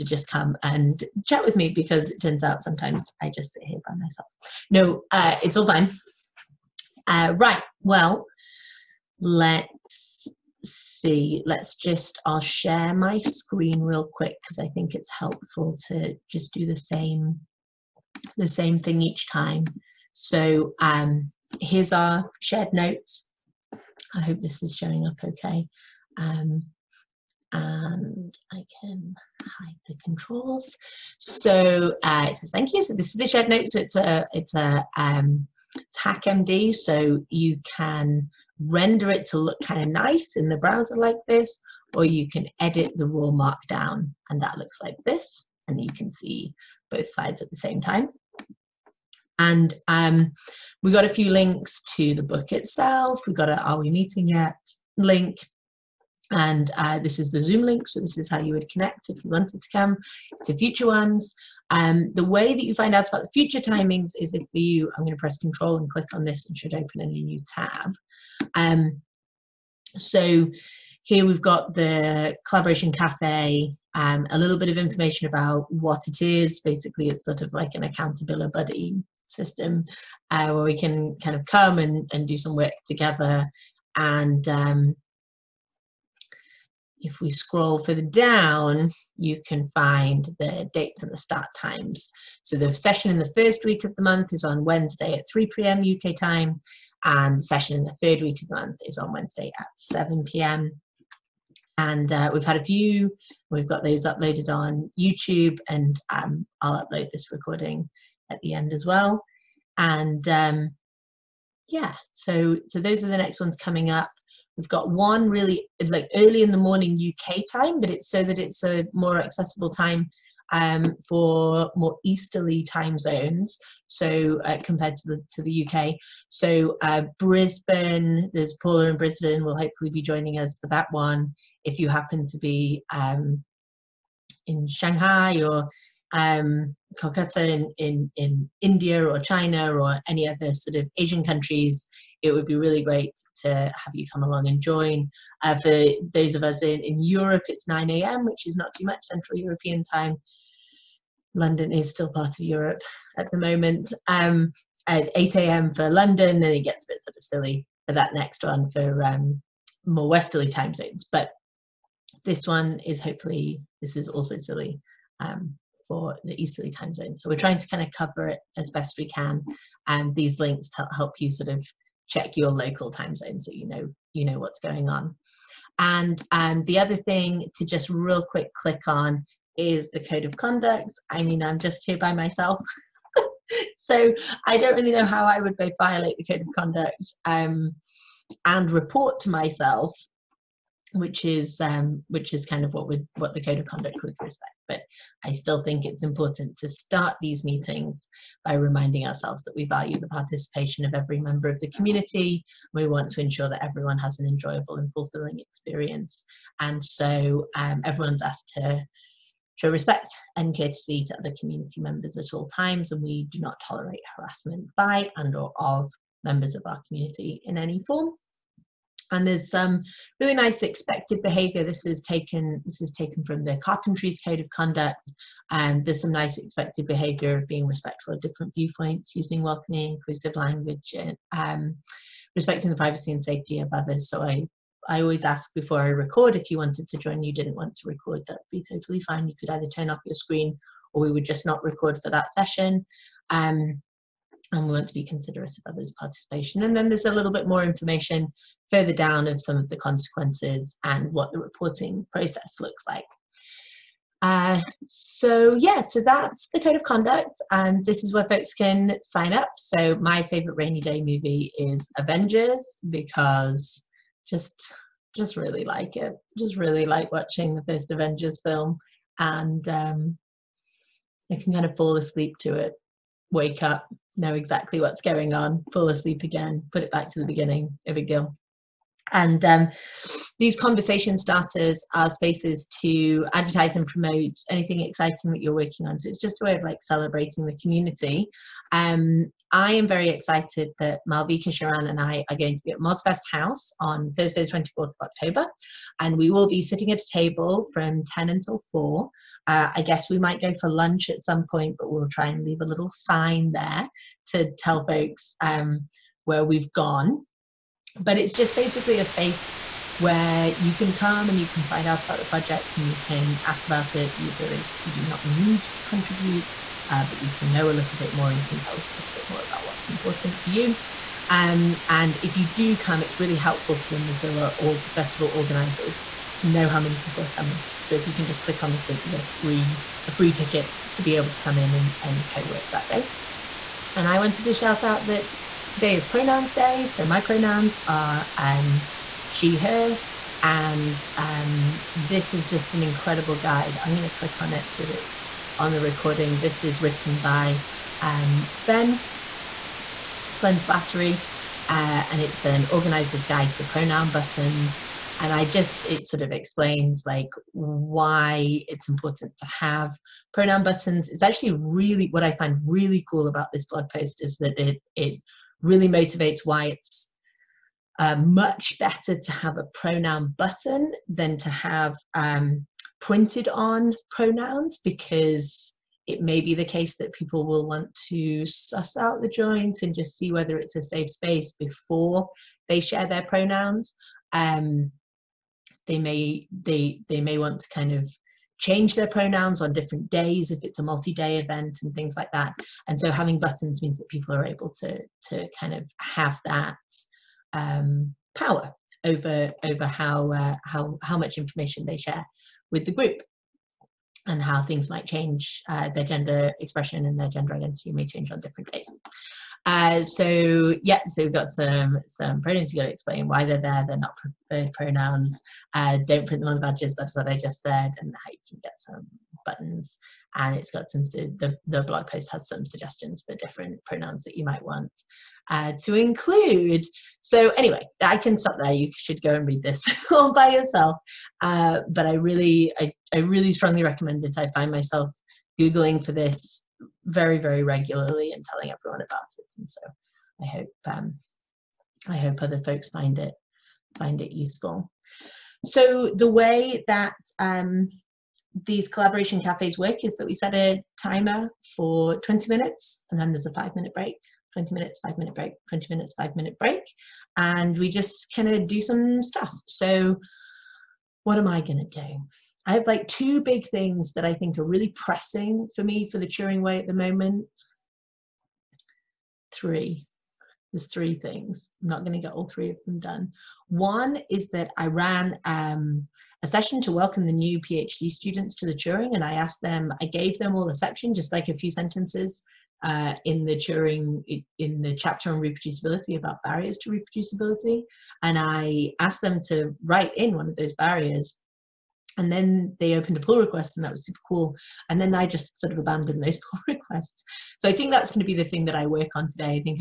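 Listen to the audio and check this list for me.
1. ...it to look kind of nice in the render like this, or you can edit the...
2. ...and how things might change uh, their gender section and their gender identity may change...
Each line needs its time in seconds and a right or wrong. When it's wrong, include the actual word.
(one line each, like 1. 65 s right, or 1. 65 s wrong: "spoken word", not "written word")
1. 39 s wrong: "browser", not "render"
2. 404 s wrong: "expression", not "section".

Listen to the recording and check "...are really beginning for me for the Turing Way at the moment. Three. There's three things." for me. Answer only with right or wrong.
wrong.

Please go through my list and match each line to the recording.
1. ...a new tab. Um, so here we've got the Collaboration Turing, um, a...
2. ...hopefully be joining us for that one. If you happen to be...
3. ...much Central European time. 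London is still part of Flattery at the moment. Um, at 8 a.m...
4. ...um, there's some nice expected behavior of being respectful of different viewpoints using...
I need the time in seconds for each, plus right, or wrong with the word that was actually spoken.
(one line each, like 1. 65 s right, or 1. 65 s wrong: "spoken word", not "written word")
1. 67 s wrong: "Cafe", not "Turing"
2. 129 s right
3. 148 s wrong: "Europe", not "Flattery"
4. 225 s right.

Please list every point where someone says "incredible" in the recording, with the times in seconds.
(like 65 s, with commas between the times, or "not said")
342 s.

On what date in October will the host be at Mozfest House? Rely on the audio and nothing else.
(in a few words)
24 October.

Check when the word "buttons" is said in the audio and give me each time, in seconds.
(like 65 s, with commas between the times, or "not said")
354 s, 360 s, 370 s, 393 s, 419 s.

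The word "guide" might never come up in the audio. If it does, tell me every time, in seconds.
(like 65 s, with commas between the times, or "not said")
343 s, 353 s.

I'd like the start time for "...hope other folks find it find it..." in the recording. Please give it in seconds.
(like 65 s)
442 s.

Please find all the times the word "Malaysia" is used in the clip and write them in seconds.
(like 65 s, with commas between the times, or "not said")
not said.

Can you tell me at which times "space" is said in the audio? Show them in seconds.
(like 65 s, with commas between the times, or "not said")
282 s, 309 s, 381 s.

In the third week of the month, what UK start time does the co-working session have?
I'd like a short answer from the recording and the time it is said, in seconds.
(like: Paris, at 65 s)
7 p.m., at 99 s.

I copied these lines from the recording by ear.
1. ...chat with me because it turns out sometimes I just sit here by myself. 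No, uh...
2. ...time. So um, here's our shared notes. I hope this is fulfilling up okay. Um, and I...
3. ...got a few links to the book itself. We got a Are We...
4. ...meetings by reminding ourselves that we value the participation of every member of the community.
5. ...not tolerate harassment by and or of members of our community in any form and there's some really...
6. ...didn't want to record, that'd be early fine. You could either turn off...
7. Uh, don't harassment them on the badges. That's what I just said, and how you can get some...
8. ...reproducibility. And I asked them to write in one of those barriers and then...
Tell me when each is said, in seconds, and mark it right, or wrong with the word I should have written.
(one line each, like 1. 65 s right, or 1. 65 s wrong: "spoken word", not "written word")
1. 1 s right
2. 19 s wrong: "showing", not "fulfilling"
3. 50 s right
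4. 197 s right
5. 213 s right
6. 237 s wrong: "totally", not "early"
7. 415 s wrong: "print", not "harassment"
8. 486 s right.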